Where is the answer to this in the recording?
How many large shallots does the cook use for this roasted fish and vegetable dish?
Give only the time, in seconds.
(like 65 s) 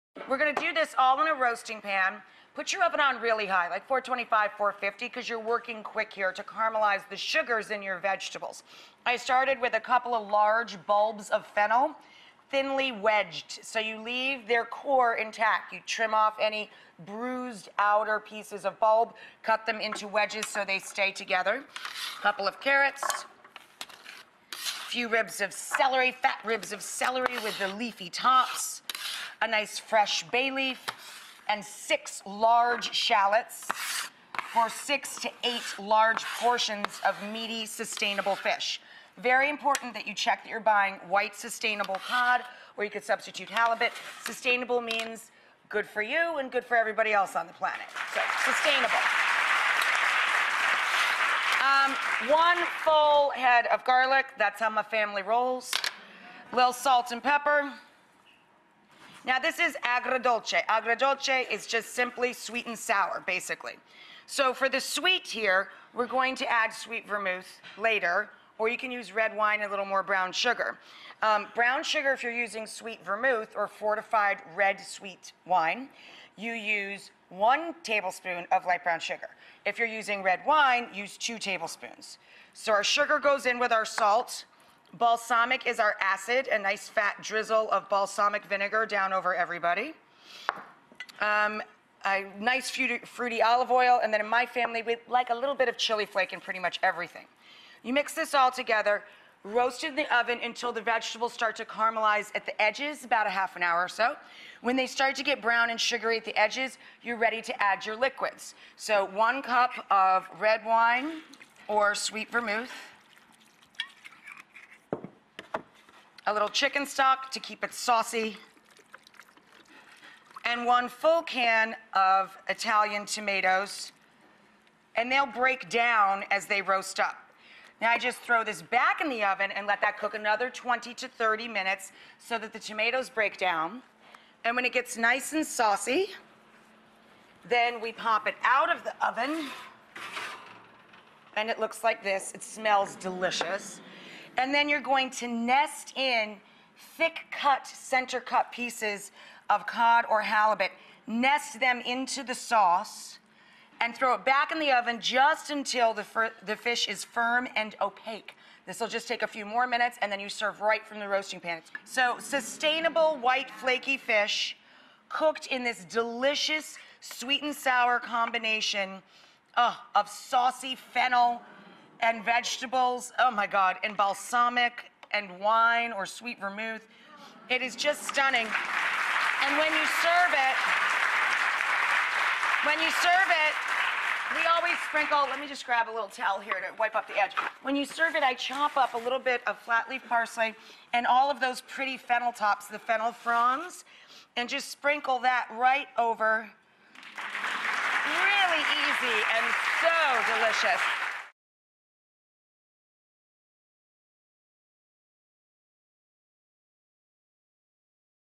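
31 s.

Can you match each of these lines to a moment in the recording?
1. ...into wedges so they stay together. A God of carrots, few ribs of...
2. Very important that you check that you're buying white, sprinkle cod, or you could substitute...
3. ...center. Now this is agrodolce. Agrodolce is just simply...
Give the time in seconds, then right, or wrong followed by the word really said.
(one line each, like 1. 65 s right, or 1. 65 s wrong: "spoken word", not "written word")
1. 19 s wrong: "Couple", not "God"
2. 39 s wrong: "sustainable", not "sprinkle"
3. 57 s wrong: "pepper", not "center".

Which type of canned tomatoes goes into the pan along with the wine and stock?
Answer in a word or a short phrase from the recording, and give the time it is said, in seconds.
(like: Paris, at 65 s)
Italian tomatoes, at 122 s.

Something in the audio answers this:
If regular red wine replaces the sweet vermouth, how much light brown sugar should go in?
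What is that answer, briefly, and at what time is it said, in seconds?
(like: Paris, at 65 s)
2 tablespoons, at 81 s.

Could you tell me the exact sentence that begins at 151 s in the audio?
Nest them into the sauce and throw it back in the oven just until the, the fish is firm and opaque.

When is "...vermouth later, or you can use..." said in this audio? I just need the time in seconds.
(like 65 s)
67 s.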